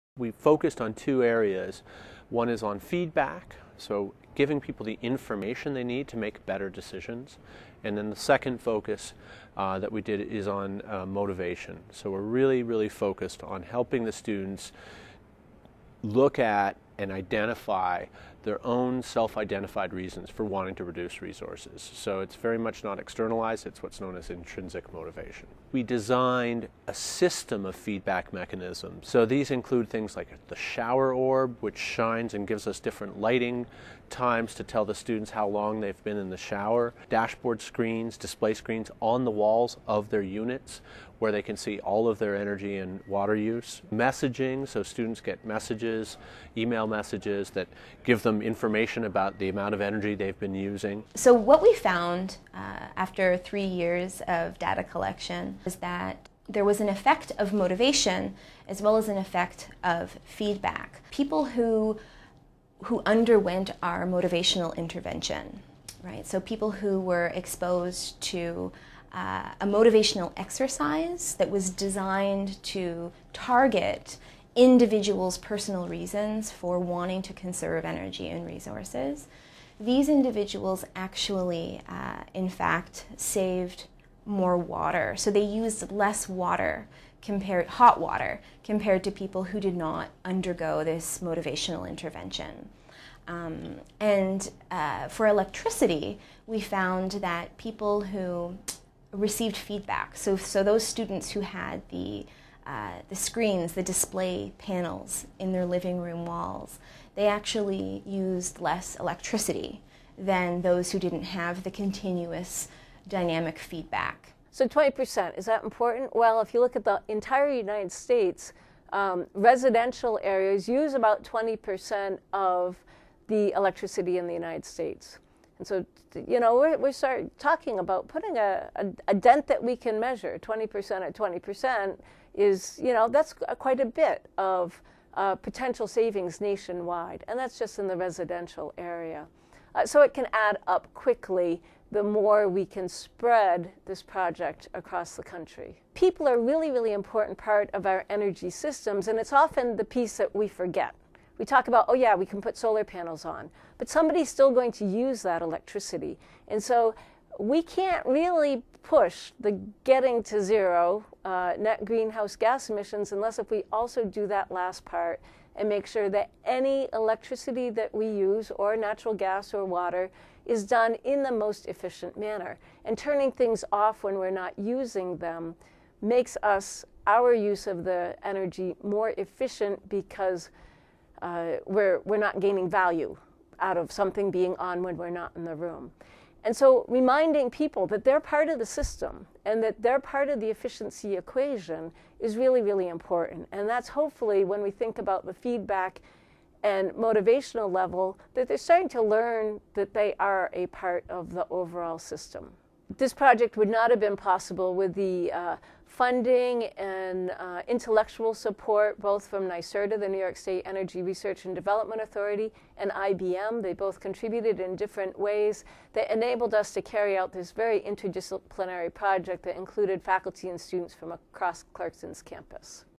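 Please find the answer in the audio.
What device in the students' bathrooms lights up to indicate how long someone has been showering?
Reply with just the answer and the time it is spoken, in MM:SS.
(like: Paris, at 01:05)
shower orb, at 00:30.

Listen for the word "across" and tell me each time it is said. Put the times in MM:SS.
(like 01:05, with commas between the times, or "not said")
02:24, 03:41.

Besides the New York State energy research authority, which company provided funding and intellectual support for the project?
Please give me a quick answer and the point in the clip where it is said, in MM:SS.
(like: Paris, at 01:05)
IBM, at 03:32.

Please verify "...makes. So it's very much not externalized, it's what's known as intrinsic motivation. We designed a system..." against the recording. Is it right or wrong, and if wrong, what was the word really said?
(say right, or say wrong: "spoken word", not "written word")
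wrong: "resources", not "makes".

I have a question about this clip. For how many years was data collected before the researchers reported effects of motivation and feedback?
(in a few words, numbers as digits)
3.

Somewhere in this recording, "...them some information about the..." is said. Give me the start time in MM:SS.
00:48.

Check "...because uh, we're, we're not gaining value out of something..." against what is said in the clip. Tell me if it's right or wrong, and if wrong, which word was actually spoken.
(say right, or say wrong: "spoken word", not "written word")
right.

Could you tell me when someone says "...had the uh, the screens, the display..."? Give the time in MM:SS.
01:41.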